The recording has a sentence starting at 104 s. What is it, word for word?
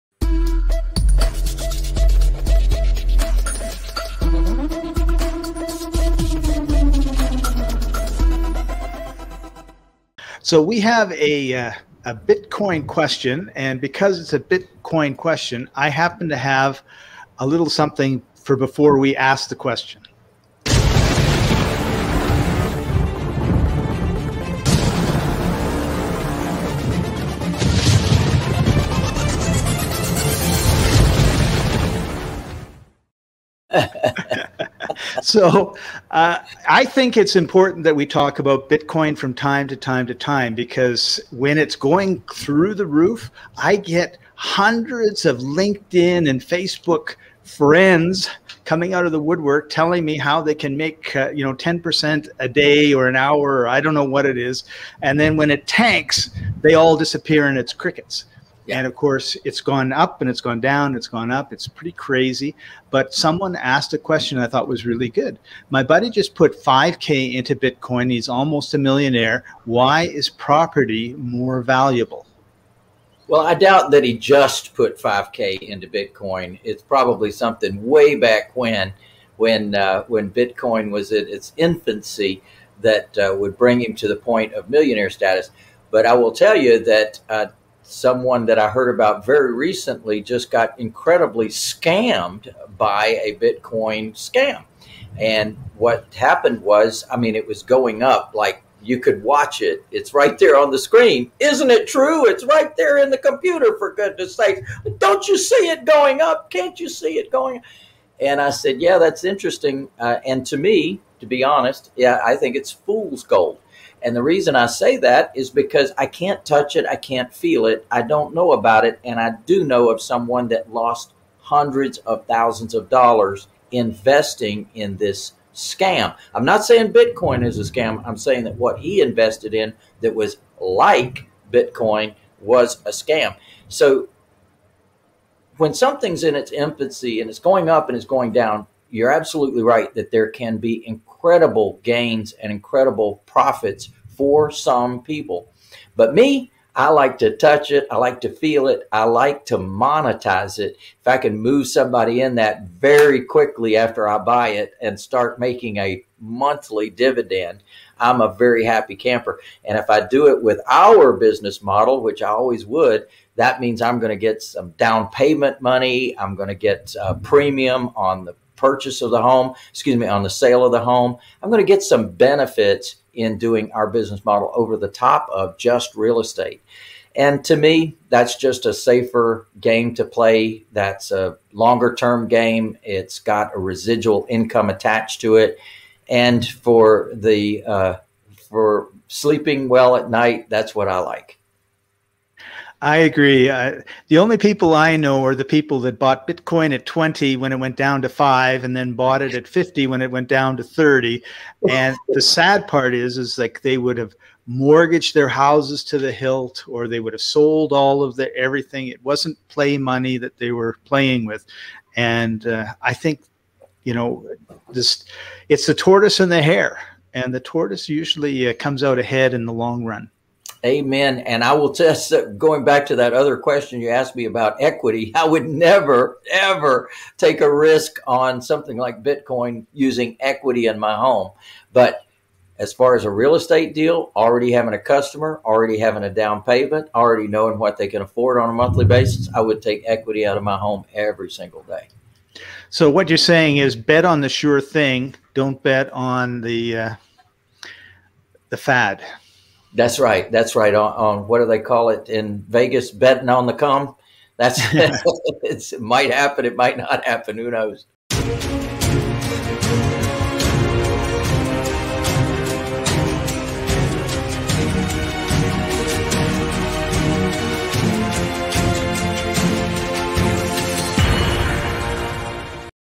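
Don't you see it going up?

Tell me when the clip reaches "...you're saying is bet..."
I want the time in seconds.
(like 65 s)
243 s.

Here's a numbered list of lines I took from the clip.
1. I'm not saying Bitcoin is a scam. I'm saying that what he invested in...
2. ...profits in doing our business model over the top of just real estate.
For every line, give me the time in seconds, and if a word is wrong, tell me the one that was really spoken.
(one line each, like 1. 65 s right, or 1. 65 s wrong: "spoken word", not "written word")
1. 126 s right
2. 172 s wrong: "benefits", not "profits".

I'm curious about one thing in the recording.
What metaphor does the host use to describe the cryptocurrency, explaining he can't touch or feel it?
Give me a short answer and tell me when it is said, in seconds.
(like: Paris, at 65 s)
Fool's gold, at 112 s.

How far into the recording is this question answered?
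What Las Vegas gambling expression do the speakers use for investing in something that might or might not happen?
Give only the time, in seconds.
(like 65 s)
252 s.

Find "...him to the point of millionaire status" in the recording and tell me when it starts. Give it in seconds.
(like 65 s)
83 s.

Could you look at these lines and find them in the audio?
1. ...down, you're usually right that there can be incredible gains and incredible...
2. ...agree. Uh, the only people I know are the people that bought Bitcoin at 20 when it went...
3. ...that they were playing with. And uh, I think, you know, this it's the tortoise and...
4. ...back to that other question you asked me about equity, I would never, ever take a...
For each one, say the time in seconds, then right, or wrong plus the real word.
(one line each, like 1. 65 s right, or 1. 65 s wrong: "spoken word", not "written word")
1. 138 s wrong: "absolutely", not "usually"
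2. 192 s right
3. 210 s right
4. 222 s right.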